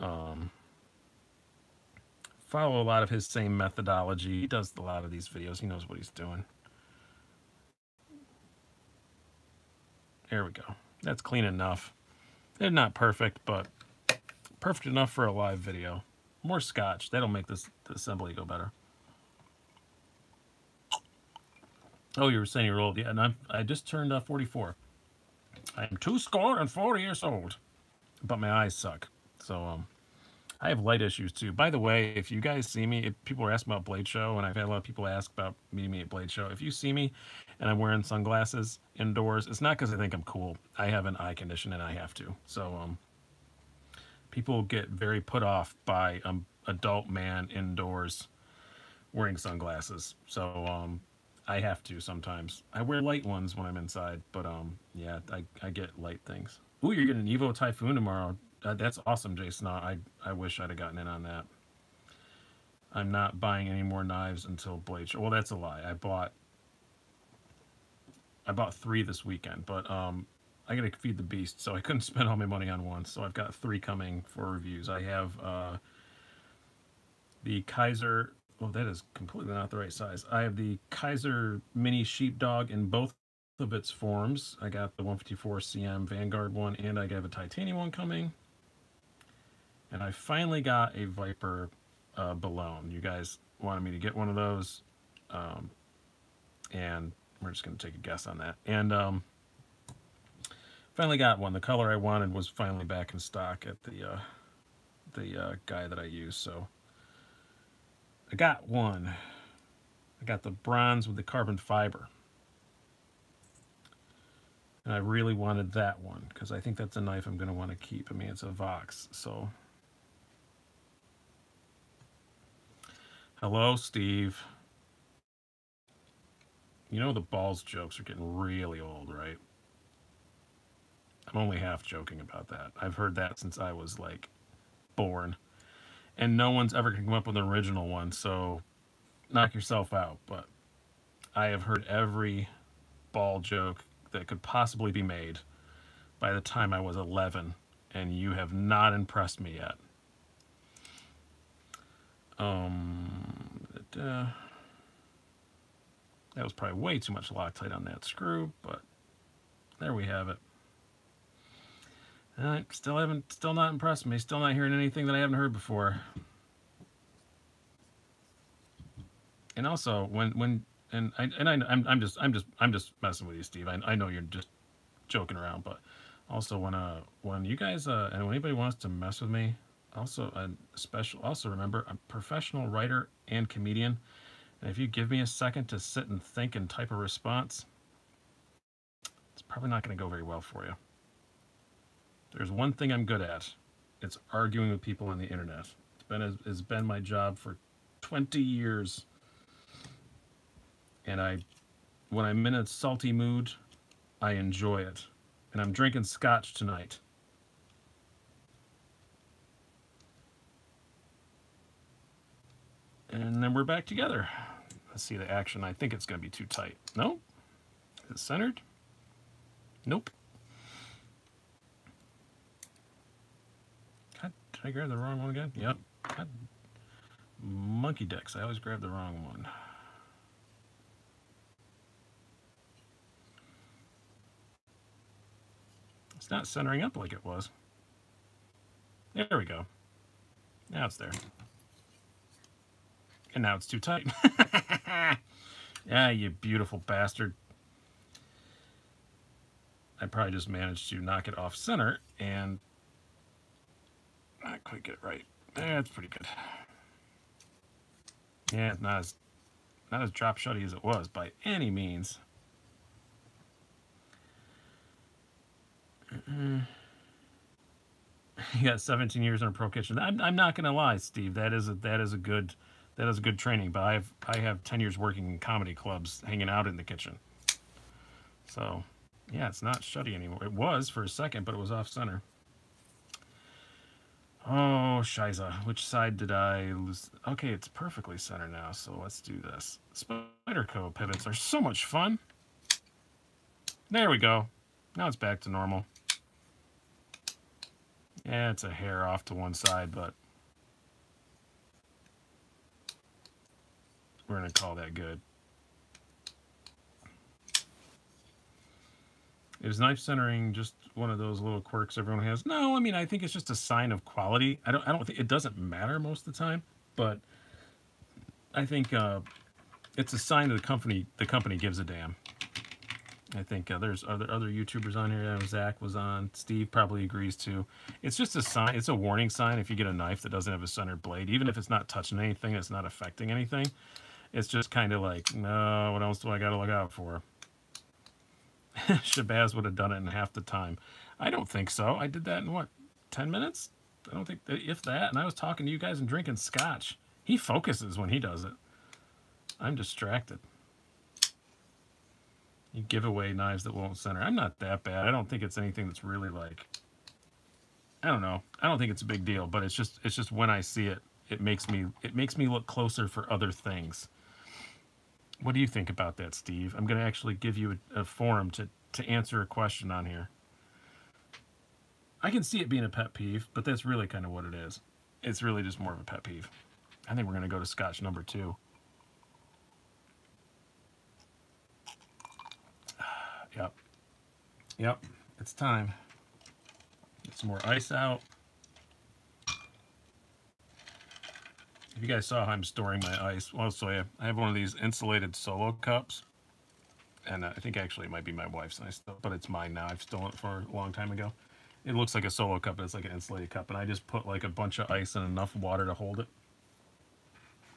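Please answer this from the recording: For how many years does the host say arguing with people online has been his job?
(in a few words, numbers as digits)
20.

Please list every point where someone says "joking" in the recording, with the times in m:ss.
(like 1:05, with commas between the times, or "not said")
2:11, 2:55.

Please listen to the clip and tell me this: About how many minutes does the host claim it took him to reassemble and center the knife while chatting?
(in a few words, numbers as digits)
10.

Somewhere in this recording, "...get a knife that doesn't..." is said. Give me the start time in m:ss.
5:29.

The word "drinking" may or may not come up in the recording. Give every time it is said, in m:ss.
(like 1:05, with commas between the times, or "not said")
3:25, 5:46.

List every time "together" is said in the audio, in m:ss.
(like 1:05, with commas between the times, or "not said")
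3:33.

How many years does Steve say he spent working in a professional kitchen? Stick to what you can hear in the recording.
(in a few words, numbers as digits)
17.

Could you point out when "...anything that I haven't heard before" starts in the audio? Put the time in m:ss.
2:44.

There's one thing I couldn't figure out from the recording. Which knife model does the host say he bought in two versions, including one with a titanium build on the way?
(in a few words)
Kizer Mini Sheepdog.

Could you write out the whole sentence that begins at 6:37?
And uh, I think actually it might be my wife's, ice, but it's mine now.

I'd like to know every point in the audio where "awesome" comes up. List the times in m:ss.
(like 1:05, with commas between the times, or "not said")
0:59.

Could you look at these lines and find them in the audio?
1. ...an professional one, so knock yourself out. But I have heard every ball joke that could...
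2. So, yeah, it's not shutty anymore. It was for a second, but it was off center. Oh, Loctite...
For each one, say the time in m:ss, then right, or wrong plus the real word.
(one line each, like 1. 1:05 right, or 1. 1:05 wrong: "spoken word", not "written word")
1. 2:17 wrong: "original", not "professional"
2. 4:38 wrong: "Shiza", not "Loctite".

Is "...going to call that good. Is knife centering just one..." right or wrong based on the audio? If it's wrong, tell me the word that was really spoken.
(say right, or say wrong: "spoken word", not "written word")
right.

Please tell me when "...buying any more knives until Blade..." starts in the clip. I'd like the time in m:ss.
1:03.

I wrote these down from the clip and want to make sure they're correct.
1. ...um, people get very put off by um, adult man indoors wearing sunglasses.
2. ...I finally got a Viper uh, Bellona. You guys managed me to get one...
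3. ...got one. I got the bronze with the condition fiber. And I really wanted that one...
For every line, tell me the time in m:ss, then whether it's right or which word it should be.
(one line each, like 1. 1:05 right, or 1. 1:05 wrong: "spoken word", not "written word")
1. 0:42 right
2. 1:30 wrong: "wanted", not "managed"
3. 1:48 wrong: "carbon", not "condition".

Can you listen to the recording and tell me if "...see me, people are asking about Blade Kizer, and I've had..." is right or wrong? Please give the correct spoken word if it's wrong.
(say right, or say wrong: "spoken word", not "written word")
wrong: "Show", not "Kizer".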